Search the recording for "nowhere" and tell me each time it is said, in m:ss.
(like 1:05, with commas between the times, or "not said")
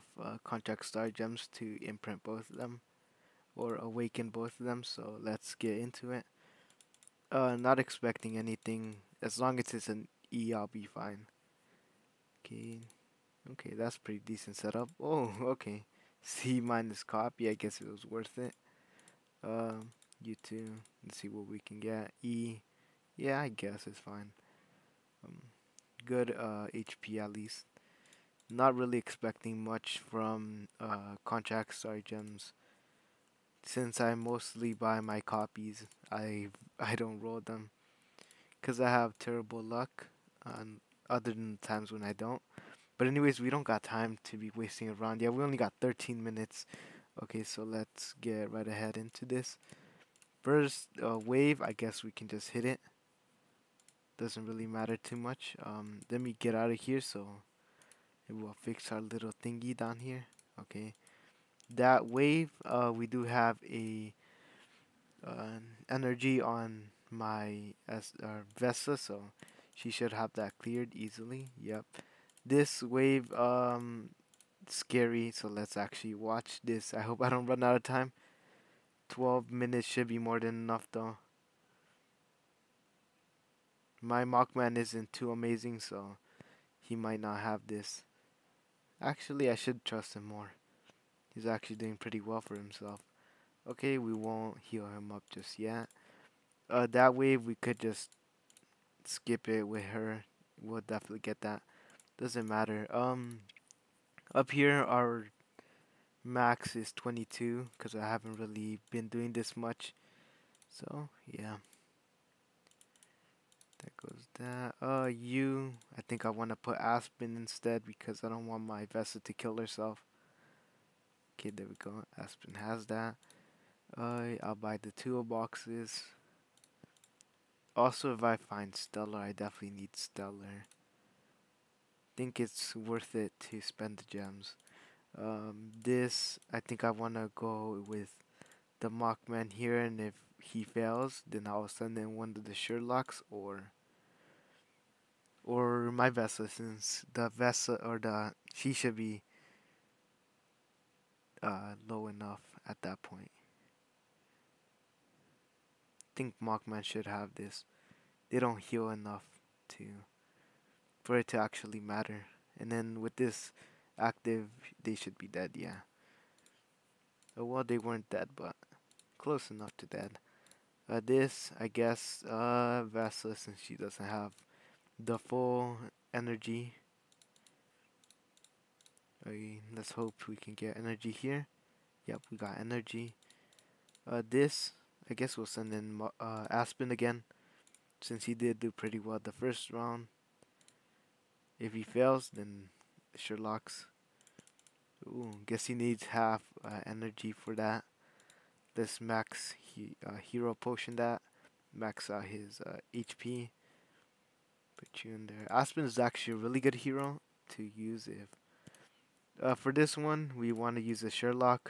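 not said.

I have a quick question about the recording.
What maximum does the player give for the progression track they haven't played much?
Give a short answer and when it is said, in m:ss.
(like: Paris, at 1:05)
22, at 1:46.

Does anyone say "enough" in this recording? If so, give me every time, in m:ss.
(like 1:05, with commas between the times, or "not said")
1:20, 2:32, 2:38, 2:49.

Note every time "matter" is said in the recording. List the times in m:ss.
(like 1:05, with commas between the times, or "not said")
0:54, 1:42, 2:41.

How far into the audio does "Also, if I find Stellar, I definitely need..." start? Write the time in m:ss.
2:07.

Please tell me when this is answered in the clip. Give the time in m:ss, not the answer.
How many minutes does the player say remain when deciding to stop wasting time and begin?
0:45.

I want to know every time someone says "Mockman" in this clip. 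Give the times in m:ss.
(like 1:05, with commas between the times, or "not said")
1:24, 2:18, 2:36.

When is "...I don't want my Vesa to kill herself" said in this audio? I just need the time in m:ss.
1:58.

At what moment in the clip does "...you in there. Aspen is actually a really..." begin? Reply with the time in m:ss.
3:25.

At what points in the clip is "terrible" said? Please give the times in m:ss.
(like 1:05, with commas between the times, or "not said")
0:39.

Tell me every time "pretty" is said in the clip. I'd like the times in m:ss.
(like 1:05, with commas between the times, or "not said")
0:13, 1:31, 3:08.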